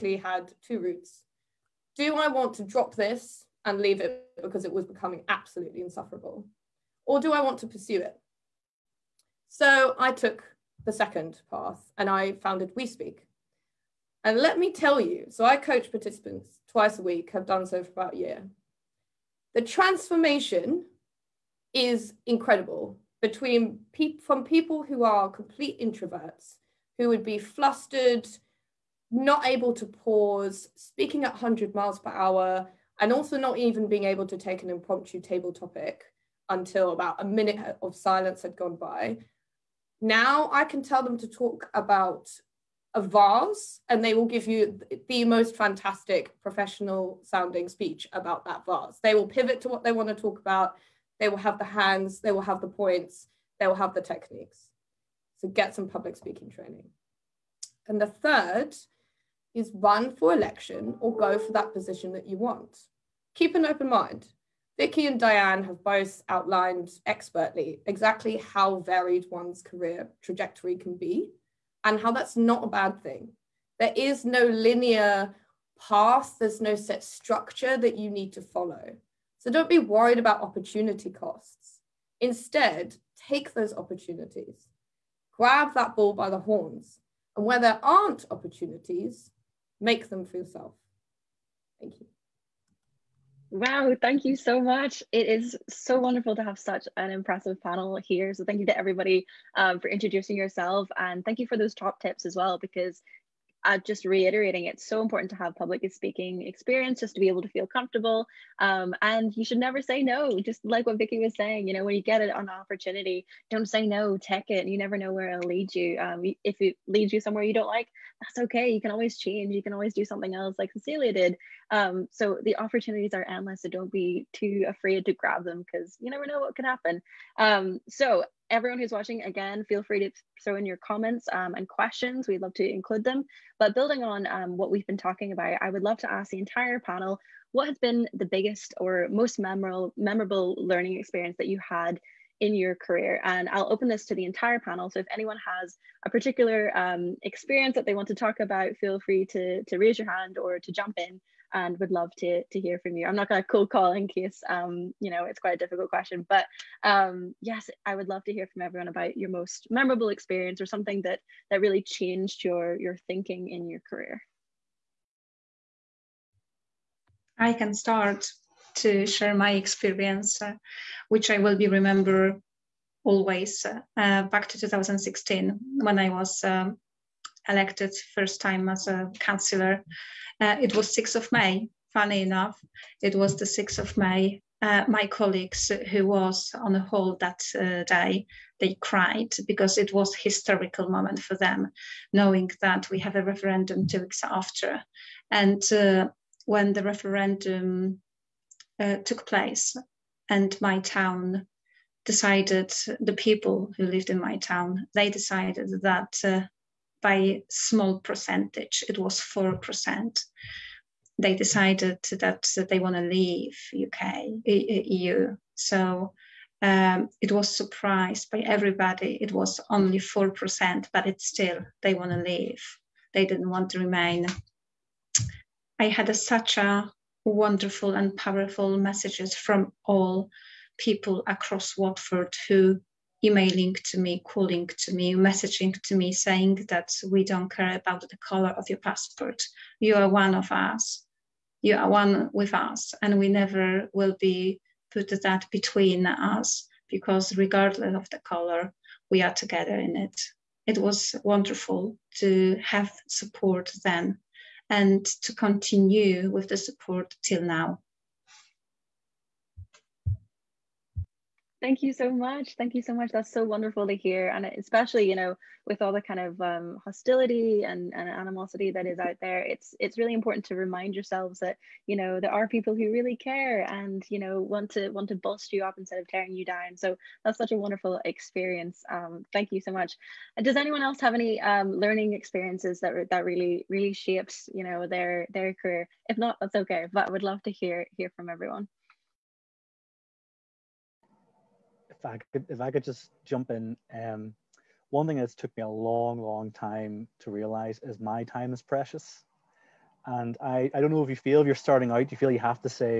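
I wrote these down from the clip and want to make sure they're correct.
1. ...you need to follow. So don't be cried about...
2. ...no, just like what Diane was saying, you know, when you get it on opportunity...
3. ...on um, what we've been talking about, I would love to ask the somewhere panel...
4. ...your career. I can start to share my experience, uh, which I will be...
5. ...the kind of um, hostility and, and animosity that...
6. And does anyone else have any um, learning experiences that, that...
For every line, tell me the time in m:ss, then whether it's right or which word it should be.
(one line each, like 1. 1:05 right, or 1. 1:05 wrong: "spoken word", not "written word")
1. 1:17 wrong: "worried", not "cried"
2. 1:50 wrong: "Vicky", not "Diane"
3. 2:14 wrong: "entire", not "somewhere"
4. 2:43 right
5. 4:25 right
6. 4:40 right.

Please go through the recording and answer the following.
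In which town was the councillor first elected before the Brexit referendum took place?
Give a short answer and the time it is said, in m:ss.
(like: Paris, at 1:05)
Watford, at 3:51.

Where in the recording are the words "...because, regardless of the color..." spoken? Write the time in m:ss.
4:06.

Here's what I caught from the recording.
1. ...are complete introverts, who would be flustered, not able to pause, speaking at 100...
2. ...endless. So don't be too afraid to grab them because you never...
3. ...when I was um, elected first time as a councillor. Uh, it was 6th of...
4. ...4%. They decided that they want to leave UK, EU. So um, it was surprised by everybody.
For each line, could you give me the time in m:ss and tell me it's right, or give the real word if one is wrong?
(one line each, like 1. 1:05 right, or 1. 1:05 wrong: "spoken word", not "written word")
1. 0:25 right
2. 2:03 right
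3. 2:55 right
4. 3:29 right.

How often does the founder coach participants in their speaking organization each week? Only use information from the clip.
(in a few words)
Twice a week.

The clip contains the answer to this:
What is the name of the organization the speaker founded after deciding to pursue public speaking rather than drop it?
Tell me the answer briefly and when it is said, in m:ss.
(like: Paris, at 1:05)
We Speak, at 0:12.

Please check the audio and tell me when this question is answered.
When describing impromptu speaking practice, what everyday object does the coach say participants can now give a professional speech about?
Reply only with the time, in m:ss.
0:42.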